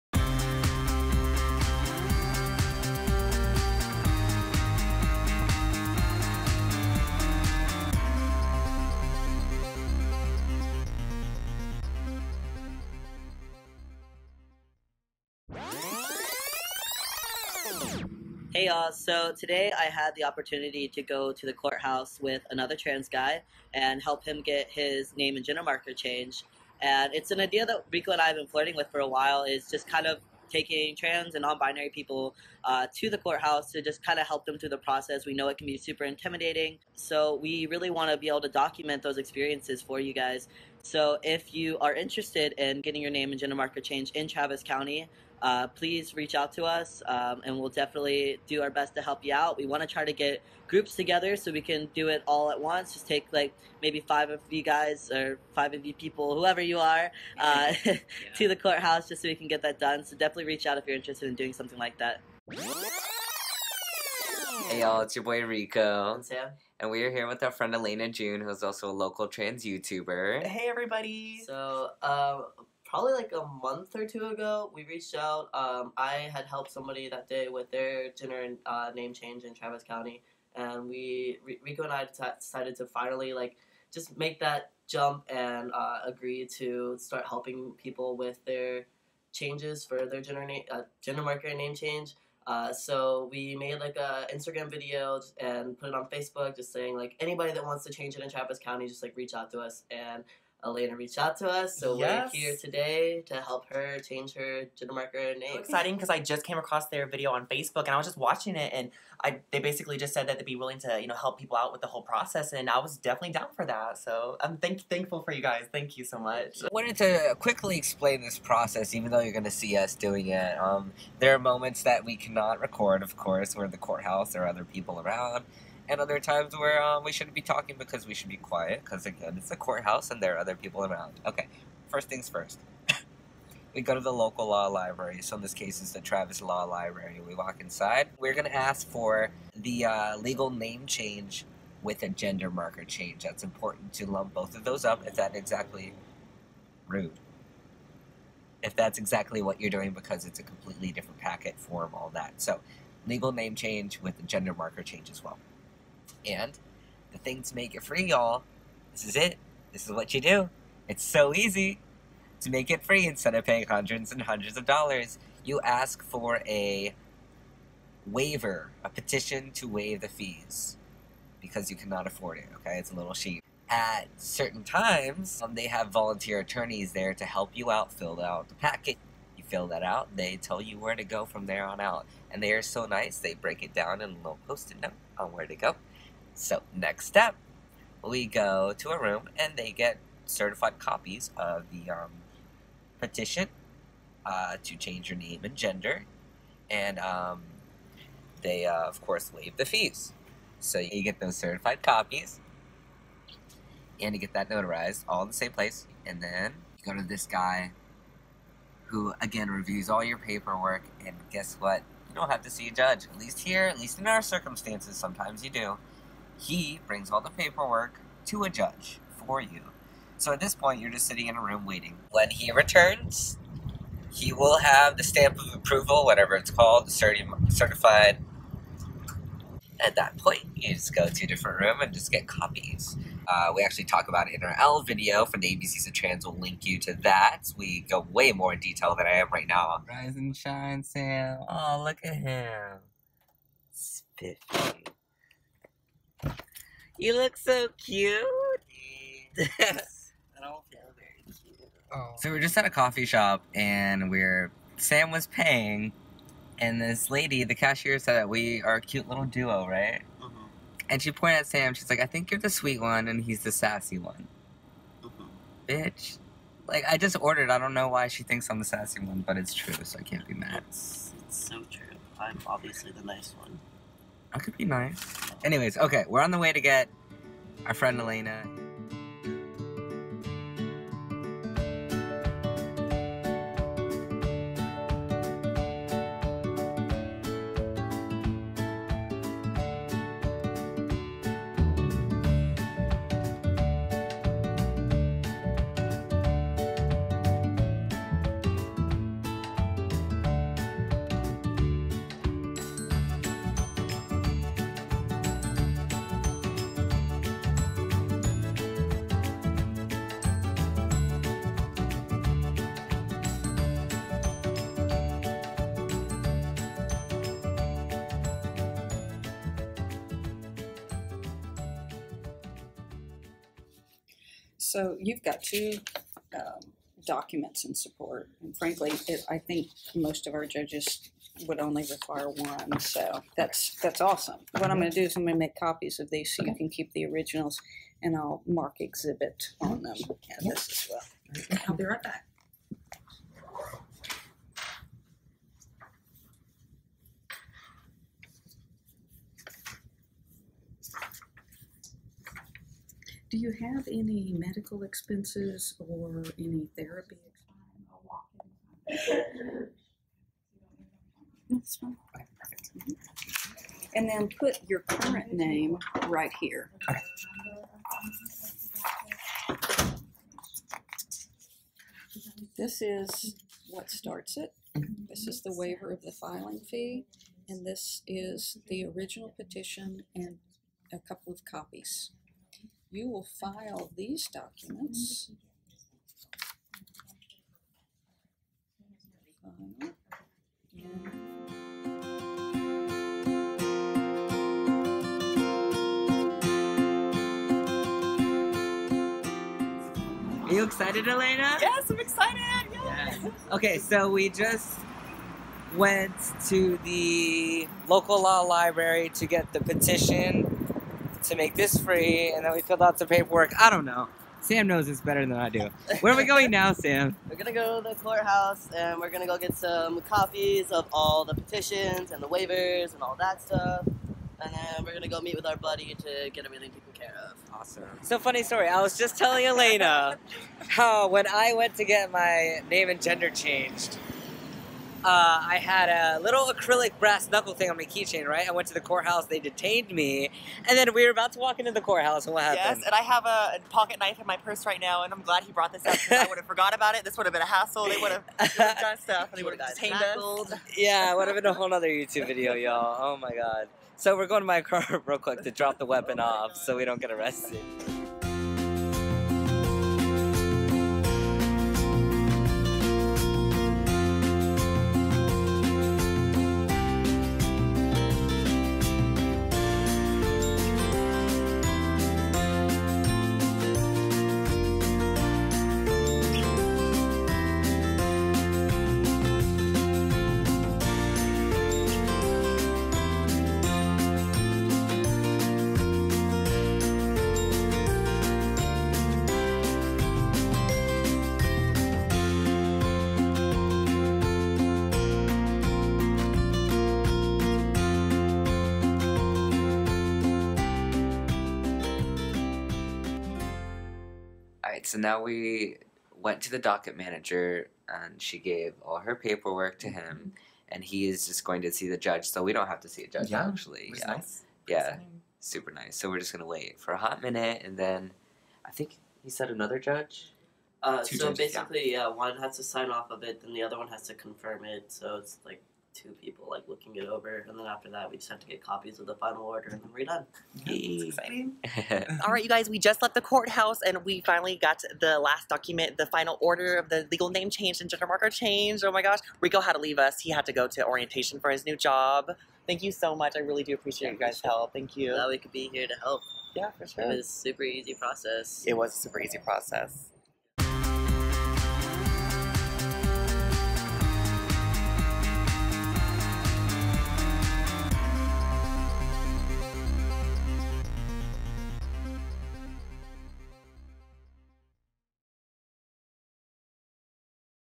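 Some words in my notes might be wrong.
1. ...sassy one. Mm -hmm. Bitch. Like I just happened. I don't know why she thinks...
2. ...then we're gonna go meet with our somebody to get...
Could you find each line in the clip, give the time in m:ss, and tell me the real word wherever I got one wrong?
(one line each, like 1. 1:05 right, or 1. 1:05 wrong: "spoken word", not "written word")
1. 4:23 wrong: "ordered", not "happened"
2. 7:04 wrong: "buddy", not "somebody".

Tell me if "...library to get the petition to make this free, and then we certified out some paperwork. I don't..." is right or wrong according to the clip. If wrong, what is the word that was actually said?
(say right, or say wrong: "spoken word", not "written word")
wrong: "filled", not "certified".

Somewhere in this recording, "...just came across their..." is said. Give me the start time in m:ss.
1:46.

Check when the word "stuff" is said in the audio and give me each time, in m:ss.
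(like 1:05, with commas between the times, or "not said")
7:03, 7:28.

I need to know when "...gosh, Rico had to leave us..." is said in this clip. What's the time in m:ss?
8:59.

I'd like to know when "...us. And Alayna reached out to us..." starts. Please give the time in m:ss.
1:39.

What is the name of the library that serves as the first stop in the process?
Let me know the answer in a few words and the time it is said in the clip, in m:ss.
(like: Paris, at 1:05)
Travis Law Library, at 2:15.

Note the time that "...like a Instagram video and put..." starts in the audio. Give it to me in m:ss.
1:33.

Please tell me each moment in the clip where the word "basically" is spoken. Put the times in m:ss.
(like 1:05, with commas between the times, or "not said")
1:49, 8:41.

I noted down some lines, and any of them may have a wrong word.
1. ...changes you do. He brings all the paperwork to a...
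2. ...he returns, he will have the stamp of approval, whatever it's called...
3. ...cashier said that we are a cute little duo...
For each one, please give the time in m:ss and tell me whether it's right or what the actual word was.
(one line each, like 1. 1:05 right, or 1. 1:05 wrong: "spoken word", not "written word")
1. 3:34 wrong: "sometimes", not "changes"
2. 3:42 right
3. 4:17 right.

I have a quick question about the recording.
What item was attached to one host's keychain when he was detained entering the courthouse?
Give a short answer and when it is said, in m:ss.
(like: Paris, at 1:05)
acrylic brass knuckle, at 7:16.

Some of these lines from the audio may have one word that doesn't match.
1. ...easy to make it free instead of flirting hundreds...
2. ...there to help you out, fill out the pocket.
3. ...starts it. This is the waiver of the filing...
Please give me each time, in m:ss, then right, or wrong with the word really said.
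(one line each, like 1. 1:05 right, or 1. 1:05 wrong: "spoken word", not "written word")
1. 2:41 wrong: "paying", not "flirting"
2. 2:56 wrong: "packet", not "pocket"
3. 6:13 right.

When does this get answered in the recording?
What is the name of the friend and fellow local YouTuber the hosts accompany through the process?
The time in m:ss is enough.
1:07.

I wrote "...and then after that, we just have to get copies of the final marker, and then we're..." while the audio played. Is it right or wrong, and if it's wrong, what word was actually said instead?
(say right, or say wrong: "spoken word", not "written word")
wrong: "order", not "marker".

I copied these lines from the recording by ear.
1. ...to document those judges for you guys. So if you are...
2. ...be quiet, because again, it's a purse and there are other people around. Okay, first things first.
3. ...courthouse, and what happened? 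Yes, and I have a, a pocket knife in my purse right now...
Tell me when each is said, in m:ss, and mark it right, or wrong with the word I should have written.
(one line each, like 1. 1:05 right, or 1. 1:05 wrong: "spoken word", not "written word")
1. 0:38 wrong: "experiences", not "judges"
2. 2:08 wrong: "courthouse", not "purse"
3. 7:21 right.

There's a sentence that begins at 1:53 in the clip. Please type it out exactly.
So I'm thank- thankful for you guys.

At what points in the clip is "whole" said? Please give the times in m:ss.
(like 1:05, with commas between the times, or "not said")
1:51, 7:31.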